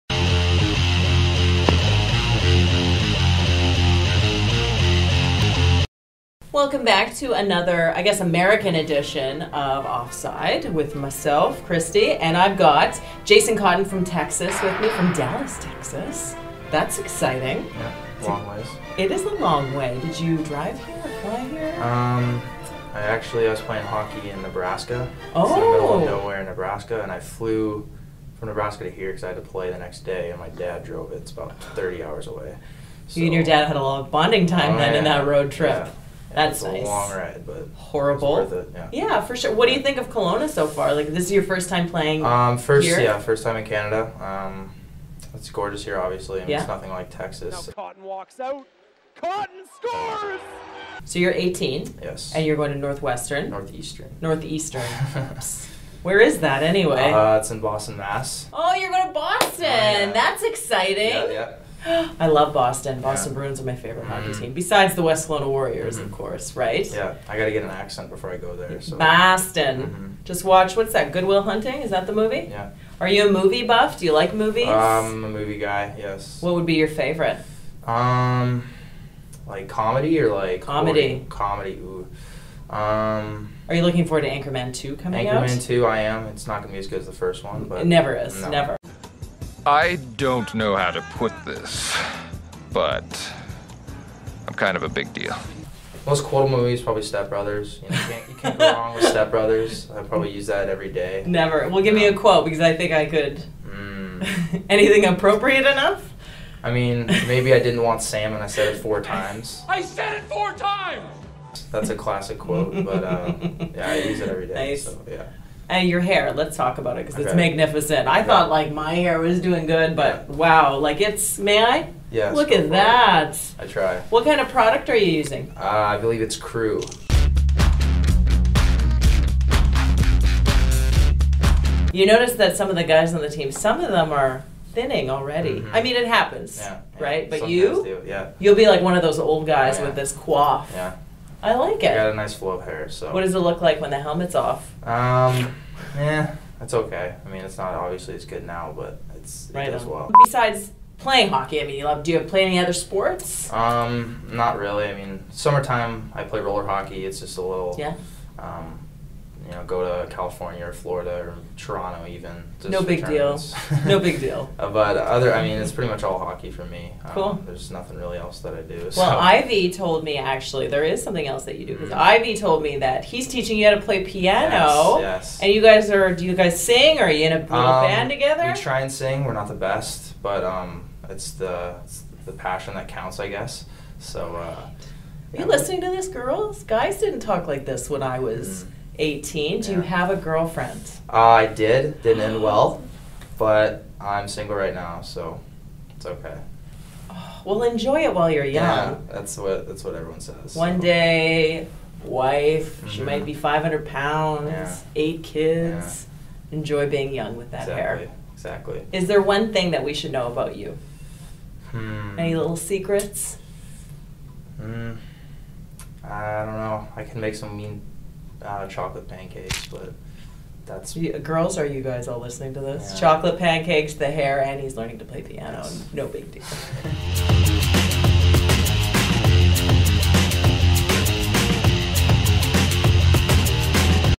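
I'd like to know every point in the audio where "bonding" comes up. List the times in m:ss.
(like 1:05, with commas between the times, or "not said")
0:34.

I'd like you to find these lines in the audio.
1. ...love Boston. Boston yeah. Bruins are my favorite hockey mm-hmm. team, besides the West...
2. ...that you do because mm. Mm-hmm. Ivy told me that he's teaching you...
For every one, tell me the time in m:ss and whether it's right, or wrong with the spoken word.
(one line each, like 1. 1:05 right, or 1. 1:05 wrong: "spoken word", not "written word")
1. 1:02 right
2. 2:51 right.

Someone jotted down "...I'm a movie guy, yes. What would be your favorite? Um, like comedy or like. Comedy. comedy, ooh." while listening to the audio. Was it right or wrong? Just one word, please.
right.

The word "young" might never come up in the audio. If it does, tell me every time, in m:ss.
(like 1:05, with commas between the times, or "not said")
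3:18, 3:27.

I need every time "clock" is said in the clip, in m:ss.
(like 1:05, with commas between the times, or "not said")
not said.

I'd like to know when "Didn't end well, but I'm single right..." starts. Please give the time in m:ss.
3:12.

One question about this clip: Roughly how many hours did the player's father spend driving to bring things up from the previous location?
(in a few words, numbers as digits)
30.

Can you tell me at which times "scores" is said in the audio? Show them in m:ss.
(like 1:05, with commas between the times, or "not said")
0:49.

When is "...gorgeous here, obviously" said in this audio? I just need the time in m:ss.
0:45.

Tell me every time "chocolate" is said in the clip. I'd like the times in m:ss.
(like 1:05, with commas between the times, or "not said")
3:38, 3:42.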